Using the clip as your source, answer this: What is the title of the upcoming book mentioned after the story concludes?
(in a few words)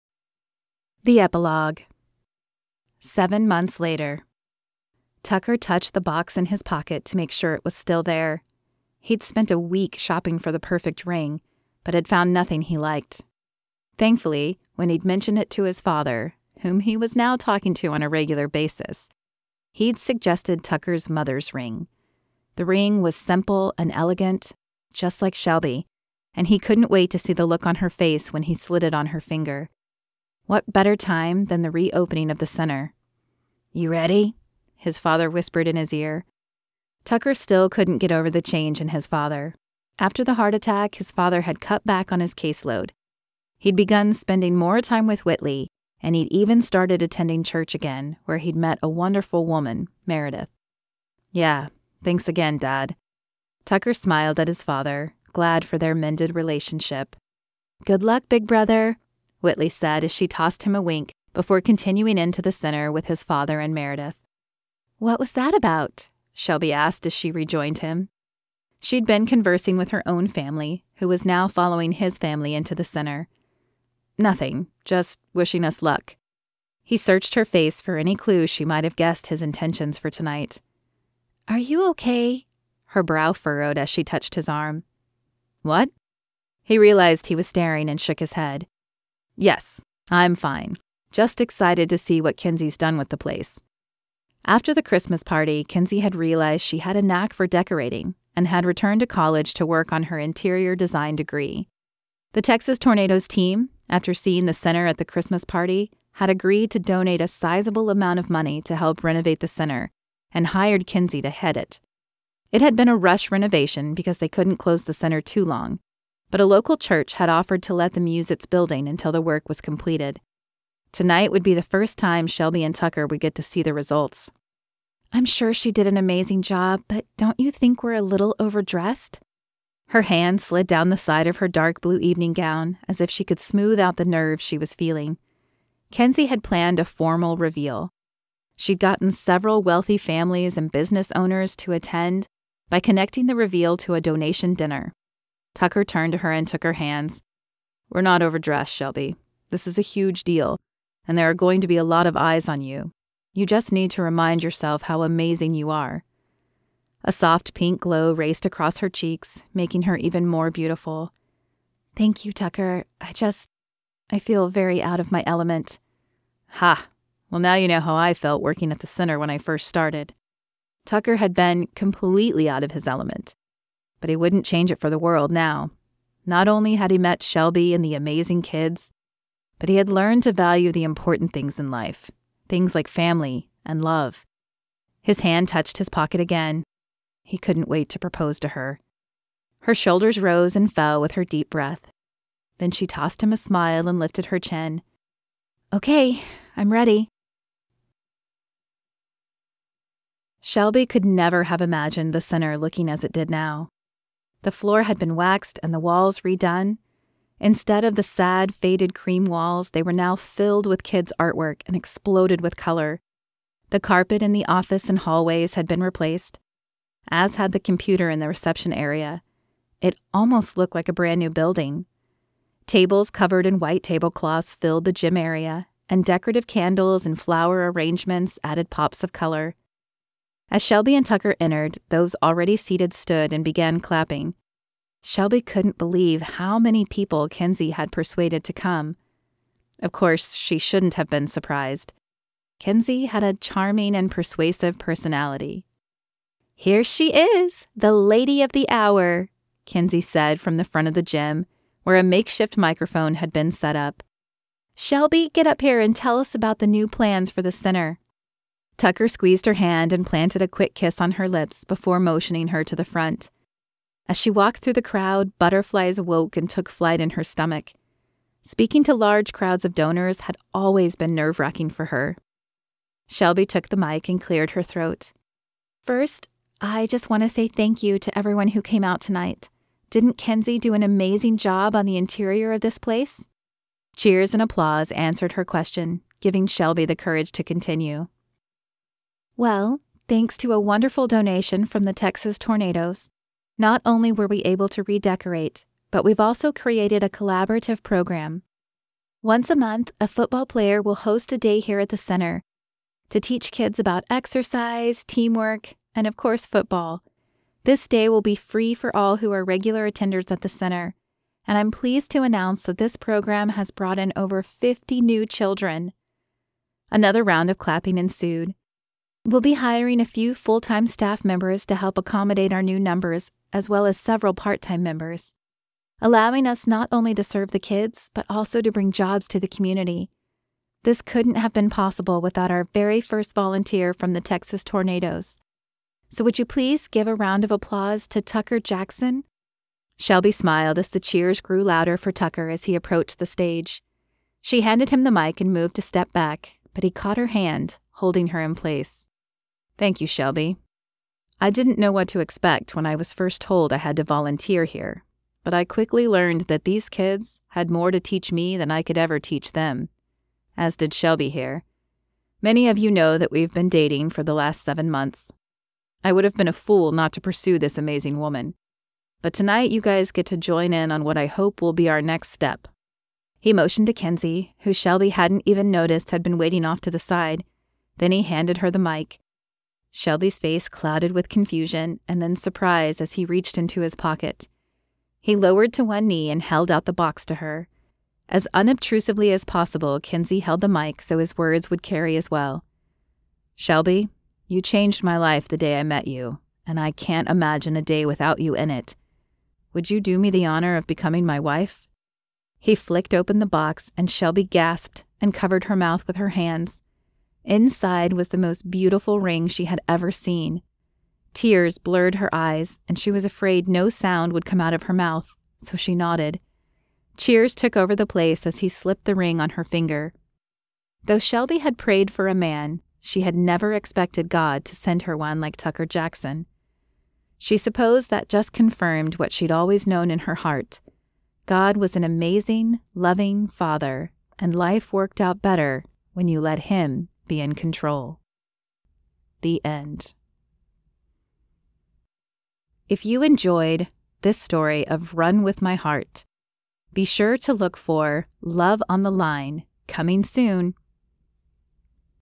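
Love on the Line.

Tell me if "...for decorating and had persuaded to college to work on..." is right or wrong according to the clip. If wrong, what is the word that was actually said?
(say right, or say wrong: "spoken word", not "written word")
wrong: "returned", not "persuaded".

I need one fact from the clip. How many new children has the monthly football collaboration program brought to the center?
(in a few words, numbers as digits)
Over 50.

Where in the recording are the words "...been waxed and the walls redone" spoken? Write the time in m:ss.
3:24.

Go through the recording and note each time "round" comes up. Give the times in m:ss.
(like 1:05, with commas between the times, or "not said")
5:17, 5:37.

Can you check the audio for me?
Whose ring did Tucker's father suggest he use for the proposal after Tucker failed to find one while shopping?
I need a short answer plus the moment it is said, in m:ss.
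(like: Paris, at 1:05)
Tucker's mother's ring, at 0:20.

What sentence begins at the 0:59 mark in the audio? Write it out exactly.
Whitley said as she tossed him a wink before continuing into the center with his father and Meredith.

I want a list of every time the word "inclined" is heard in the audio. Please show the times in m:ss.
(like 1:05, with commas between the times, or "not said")
not said.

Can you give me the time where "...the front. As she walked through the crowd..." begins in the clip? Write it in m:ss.
4:22.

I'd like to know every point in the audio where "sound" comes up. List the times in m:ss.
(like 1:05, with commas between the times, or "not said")
6:53.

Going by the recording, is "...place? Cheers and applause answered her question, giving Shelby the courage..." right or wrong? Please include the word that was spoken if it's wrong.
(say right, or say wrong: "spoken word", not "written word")
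right.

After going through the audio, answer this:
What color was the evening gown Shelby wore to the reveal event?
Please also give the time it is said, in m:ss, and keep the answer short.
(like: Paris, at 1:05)
Dark blue, at 2:11.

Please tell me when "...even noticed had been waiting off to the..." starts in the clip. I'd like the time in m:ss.
6:15.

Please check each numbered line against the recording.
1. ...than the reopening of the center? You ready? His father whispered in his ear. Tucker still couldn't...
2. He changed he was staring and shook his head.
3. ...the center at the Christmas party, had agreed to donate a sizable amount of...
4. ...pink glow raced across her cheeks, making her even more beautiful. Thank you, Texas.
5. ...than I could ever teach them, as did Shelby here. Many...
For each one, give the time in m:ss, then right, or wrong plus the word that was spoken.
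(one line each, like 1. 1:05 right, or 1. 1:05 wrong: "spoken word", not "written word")
1. 0:31 right
2. 1:26 wrong: "realized", not "changed"
3. 1:44 right
4. 2:37 wrong: "Tucker", not "Texas"
5. 5:58 right.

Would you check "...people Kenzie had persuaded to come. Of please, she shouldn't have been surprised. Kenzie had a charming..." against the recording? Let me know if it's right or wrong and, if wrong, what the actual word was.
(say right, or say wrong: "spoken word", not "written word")
wrong: "course", not "please".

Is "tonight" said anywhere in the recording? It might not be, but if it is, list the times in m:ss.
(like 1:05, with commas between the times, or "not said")
1:20, 2:00, 4:38, 6:09.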